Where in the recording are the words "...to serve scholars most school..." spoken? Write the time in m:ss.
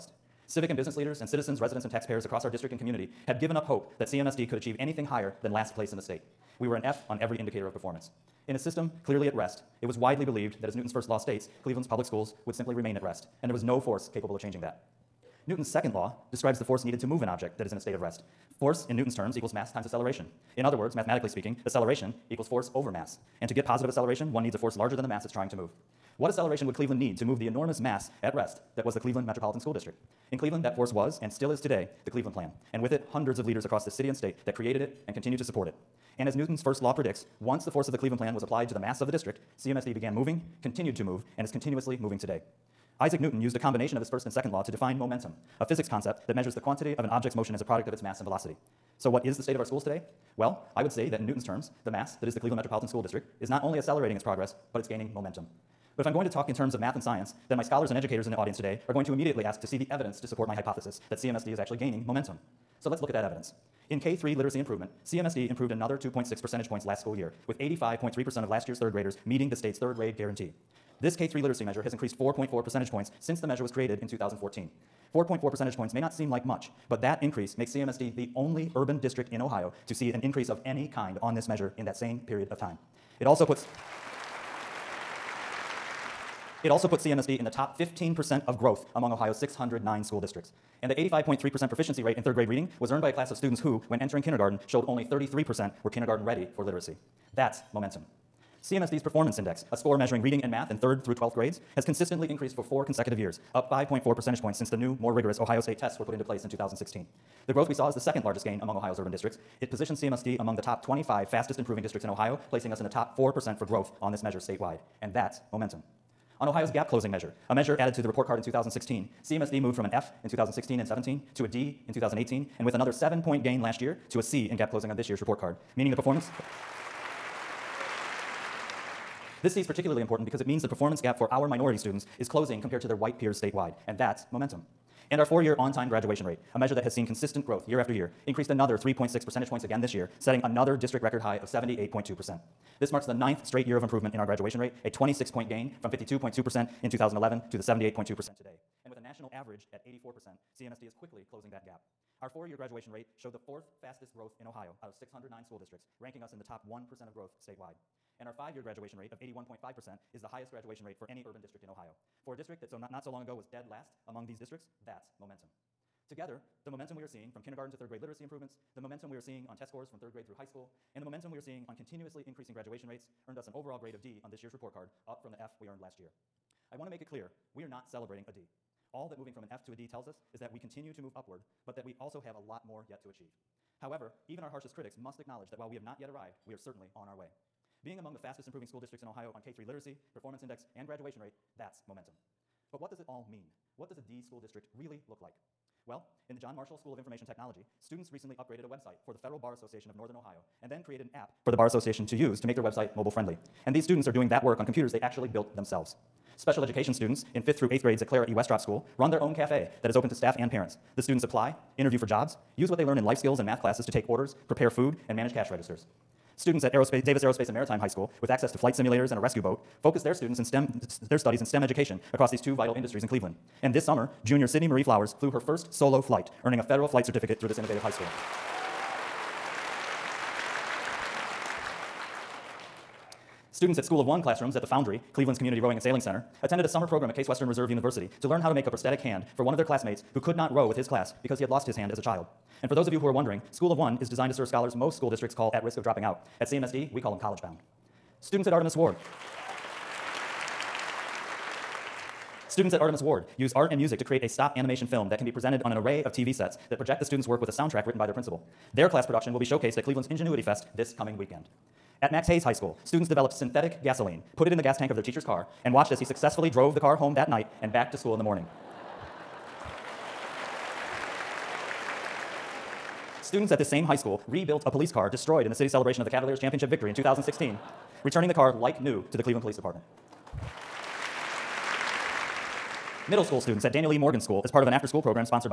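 4:04.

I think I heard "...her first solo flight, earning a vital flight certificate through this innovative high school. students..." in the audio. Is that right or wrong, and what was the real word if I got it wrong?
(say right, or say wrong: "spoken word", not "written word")
wrong: "federal", not "vital".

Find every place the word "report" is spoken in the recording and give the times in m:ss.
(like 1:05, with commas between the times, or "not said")
1:58, 2:05, 2:54.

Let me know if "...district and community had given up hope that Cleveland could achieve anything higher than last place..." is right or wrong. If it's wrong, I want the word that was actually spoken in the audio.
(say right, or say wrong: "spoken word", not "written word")
wrong: "CMSD", not "Cleveland".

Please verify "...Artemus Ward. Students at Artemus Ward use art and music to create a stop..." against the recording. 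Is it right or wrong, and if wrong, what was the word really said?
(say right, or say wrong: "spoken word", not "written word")
right.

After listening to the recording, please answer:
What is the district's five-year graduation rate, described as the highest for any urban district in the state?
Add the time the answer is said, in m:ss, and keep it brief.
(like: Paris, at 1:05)
81.5%, at 2:39.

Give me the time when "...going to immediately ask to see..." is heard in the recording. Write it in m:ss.
0:58.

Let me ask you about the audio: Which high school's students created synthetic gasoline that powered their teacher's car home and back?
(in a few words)
Max Hayes High School.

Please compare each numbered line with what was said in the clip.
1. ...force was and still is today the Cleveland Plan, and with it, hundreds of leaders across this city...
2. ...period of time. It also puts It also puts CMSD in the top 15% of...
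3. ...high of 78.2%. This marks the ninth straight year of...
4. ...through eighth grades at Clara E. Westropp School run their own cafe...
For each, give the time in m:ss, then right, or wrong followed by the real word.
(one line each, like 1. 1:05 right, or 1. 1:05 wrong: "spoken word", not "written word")
1. 0:30 right
2. 1:22 right
3. 2:21 right
4. 3:27 right.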